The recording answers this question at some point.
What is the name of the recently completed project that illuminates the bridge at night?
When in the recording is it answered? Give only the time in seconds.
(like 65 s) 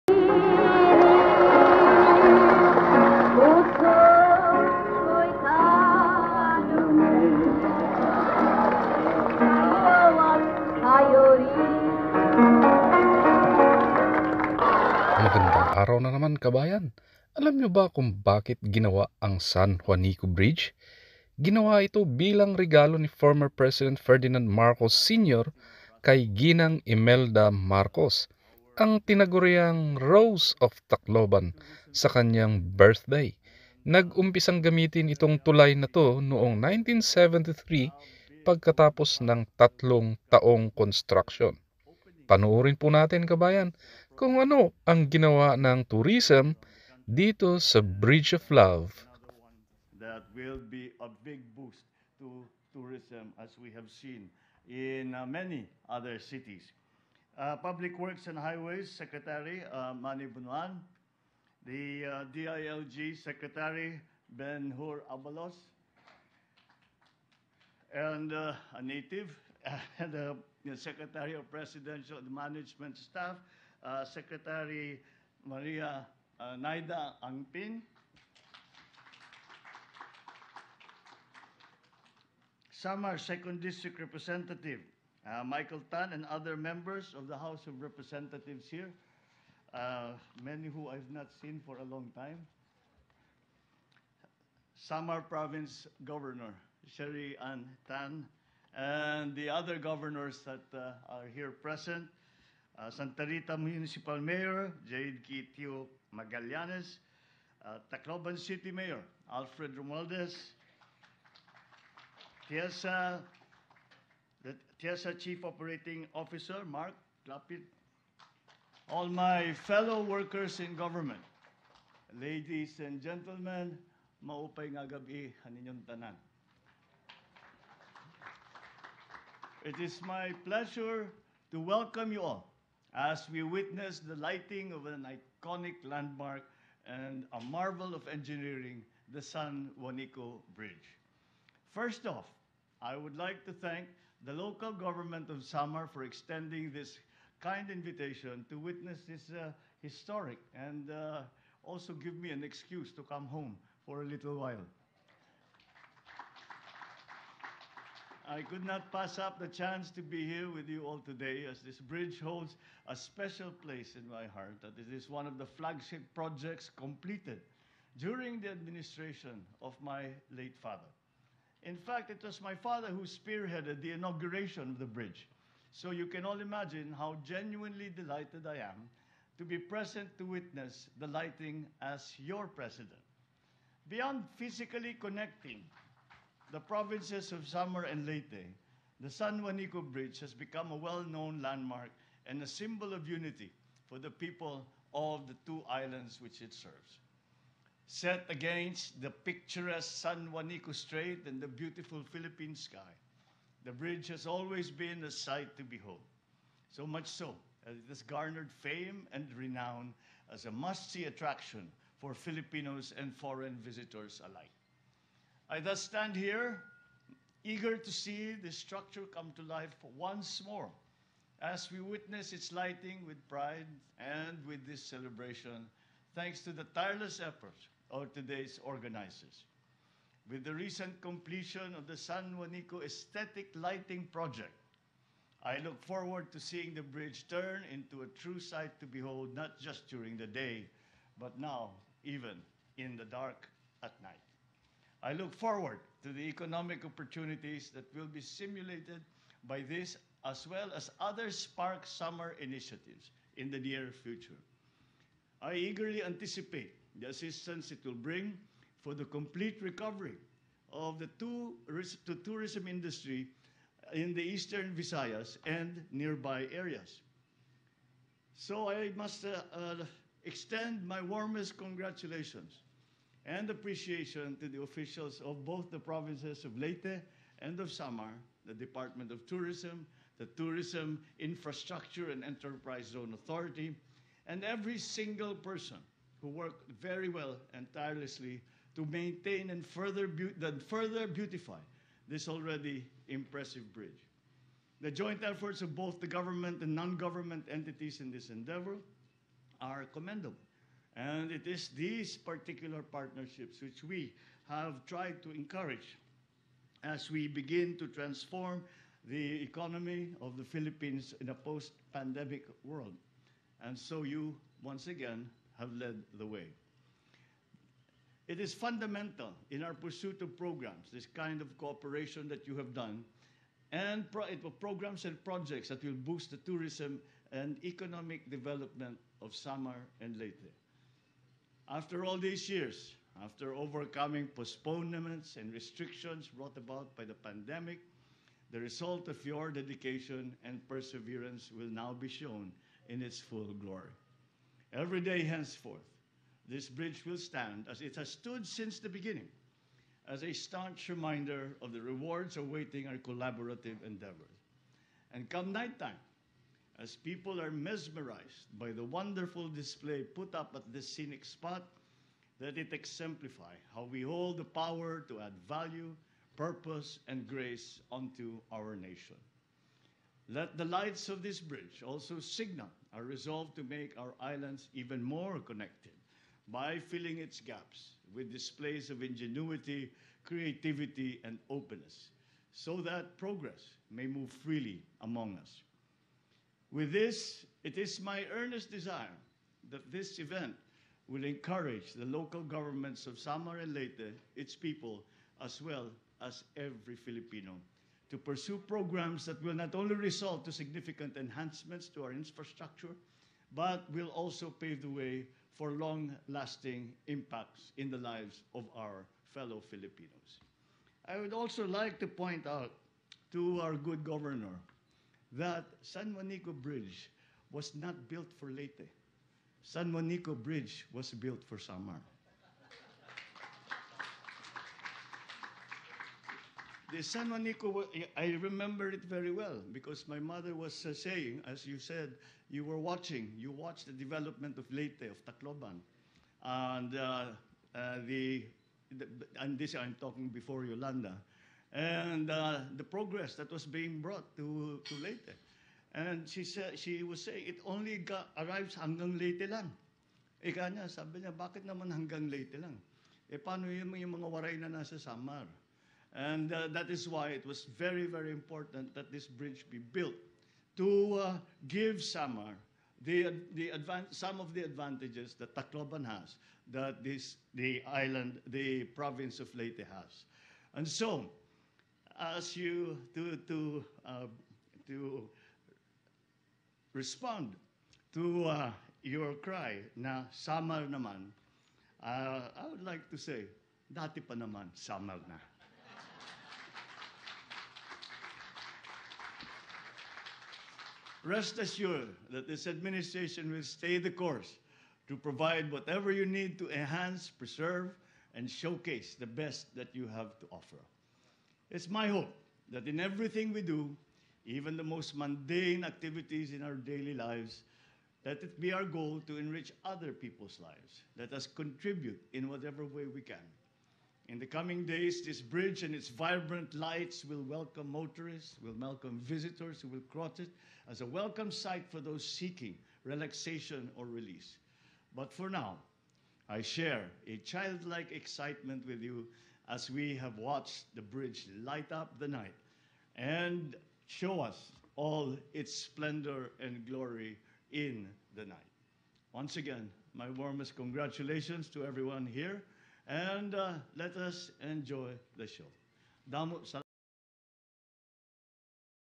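231 s.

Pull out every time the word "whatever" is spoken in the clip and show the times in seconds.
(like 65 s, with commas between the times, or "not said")
495 s, 512 s.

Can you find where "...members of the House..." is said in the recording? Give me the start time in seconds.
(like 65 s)
86 s.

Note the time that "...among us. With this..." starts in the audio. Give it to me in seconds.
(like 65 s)
385 s.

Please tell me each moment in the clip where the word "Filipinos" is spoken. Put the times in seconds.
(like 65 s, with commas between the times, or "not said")
212 s, 396 s, 409 s.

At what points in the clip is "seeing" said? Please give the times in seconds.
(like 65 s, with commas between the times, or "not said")
236 s.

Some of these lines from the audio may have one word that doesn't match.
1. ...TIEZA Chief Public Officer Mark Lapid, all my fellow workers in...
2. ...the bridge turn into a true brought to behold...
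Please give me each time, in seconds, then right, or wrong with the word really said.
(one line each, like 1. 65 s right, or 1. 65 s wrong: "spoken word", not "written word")
1. 114 s wrong: "Operating", not "Public"
2. 236 s wrong: "sight", not "brought".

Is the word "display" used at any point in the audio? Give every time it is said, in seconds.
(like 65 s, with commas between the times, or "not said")
359 s, 378 s.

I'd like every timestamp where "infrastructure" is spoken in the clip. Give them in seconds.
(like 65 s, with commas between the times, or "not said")
281 s, 402 s.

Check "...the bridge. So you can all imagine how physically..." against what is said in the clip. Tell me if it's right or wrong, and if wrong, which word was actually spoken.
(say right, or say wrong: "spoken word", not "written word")
wrong: "genuinely", not "physically".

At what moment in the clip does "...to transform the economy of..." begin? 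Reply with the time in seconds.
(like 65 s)
307 s.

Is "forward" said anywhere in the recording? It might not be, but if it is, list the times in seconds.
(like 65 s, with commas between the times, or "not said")
235 s, 245 s.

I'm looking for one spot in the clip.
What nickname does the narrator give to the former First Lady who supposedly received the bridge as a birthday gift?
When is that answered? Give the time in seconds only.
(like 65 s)
29 s.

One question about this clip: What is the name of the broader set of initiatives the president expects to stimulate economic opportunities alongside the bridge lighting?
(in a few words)
Spark Samar.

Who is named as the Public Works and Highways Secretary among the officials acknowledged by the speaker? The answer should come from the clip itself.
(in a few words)
Manny Bonoan.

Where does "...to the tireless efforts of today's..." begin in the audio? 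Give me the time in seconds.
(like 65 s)
226 s.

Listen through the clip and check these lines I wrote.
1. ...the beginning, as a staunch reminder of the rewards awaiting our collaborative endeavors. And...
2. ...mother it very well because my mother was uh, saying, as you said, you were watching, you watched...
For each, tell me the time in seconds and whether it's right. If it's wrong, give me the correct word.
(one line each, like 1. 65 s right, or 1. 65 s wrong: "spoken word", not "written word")
1. 348 s right
2. 428 s wrong: "remember", not "mother".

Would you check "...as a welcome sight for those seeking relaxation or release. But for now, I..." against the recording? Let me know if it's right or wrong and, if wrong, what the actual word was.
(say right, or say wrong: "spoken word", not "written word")
right.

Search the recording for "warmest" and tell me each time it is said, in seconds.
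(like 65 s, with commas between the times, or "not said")
271 s, 540 s.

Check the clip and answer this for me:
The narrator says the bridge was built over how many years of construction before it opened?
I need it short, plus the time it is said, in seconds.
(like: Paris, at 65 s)
3, at 39 s.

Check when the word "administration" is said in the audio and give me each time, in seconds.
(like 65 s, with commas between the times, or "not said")
168 s, 492 s.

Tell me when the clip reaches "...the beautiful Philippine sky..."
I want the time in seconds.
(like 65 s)
201 s.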